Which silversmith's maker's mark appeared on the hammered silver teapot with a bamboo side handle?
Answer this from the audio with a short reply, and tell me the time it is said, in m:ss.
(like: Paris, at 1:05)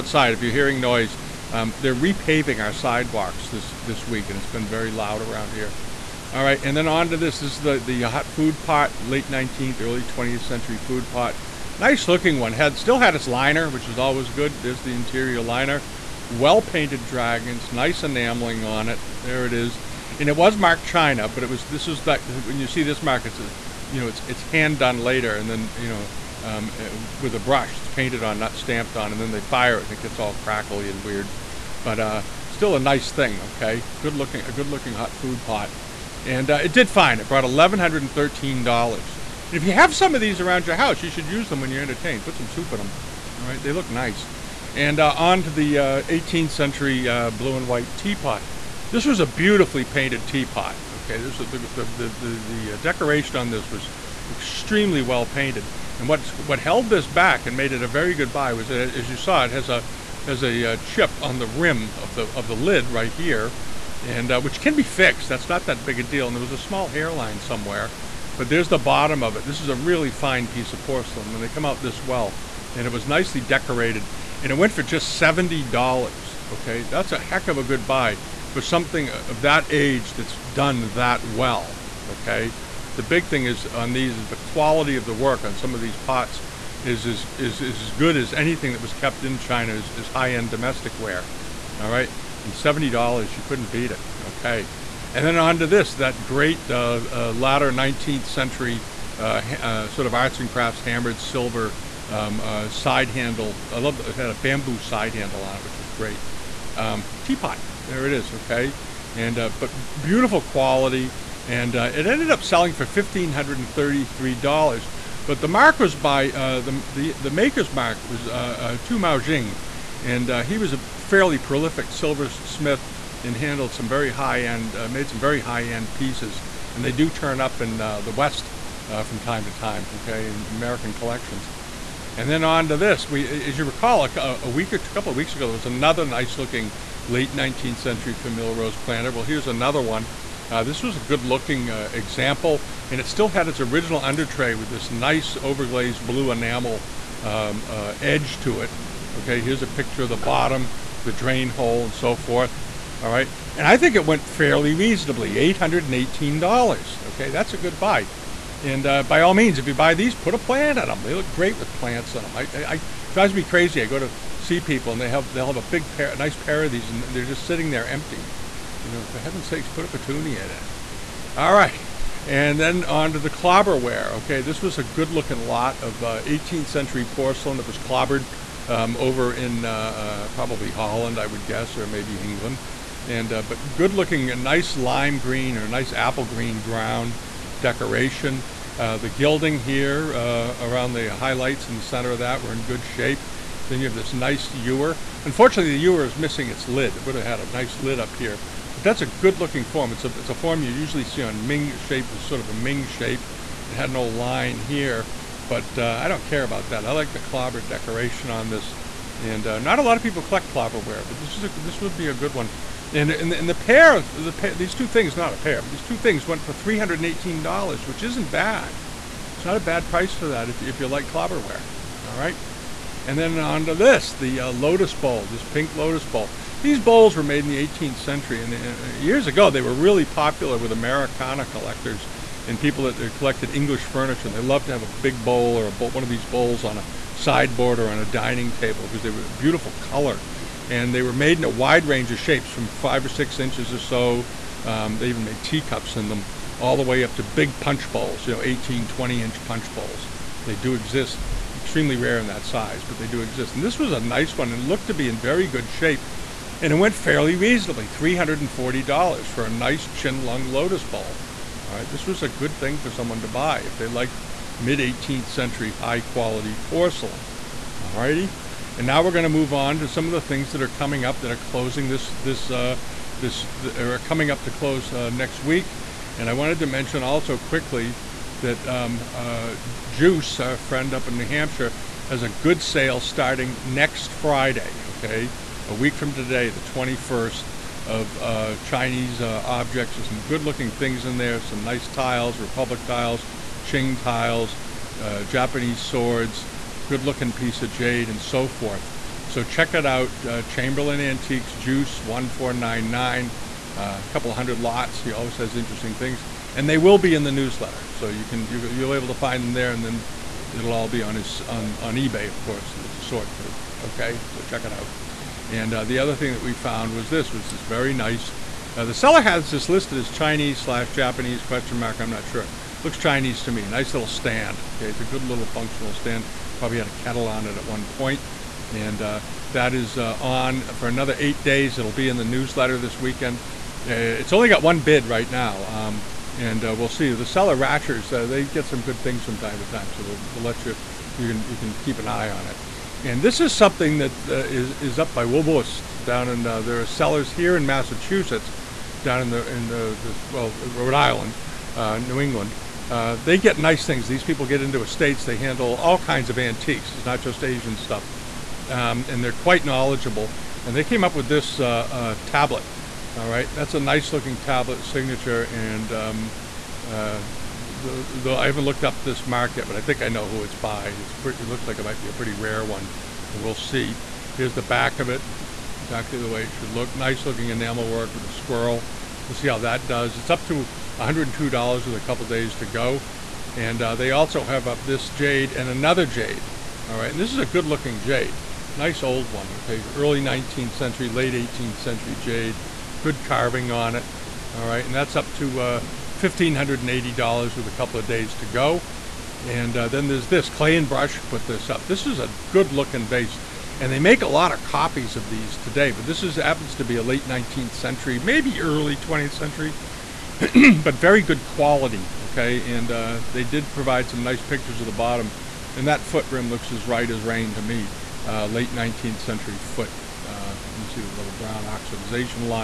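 Tu Mao Jing, at 1:58.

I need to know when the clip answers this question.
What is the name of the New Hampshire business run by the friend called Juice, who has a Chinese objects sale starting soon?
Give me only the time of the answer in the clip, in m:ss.
5:00.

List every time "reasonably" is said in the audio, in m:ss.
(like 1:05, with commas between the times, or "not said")
2:34, 4:17.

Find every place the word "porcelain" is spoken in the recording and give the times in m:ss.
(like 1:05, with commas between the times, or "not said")
1:10, 2:57, 4:26.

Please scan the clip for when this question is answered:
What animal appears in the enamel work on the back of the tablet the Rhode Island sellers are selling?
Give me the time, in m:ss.
6:18.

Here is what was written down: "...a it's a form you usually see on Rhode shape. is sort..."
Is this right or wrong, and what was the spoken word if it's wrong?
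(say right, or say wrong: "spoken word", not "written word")
wrong: "Ming", not "Rhode".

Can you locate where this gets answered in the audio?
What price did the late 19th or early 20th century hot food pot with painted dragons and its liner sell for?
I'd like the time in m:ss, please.
0:37.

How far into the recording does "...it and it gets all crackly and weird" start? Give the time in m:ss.
0:29.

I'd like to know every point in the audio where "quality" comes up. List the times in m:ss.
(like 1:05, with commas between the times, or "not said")
1:24, 1:50, 4:26, 6:51.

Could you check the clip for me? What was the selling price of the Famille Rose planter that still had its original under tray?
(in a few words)
$818.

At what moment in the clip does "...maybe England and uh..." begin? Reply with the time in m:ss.
3:01.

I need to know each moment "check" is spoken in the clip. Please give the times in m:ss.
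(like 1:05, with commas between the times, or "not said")
4:59, 5:14.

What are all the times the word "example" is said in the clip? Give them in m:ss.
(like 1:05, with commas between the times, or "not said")
2:21.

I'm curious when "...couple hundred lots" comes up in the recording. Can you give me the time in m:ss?
5:04.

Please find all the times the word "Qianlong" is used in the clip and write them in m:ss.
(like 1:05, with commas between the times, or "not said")
4:19.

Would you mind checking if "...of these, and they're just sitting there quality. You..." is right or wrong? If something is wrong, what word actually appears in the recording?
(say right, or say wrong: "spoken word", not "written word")
wrong: "empty", not "quality".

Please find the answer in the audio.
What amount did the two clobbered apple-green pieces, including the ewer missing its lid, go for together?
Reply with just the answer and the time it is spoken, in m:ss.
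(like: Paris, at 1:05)
$318, at 3:36.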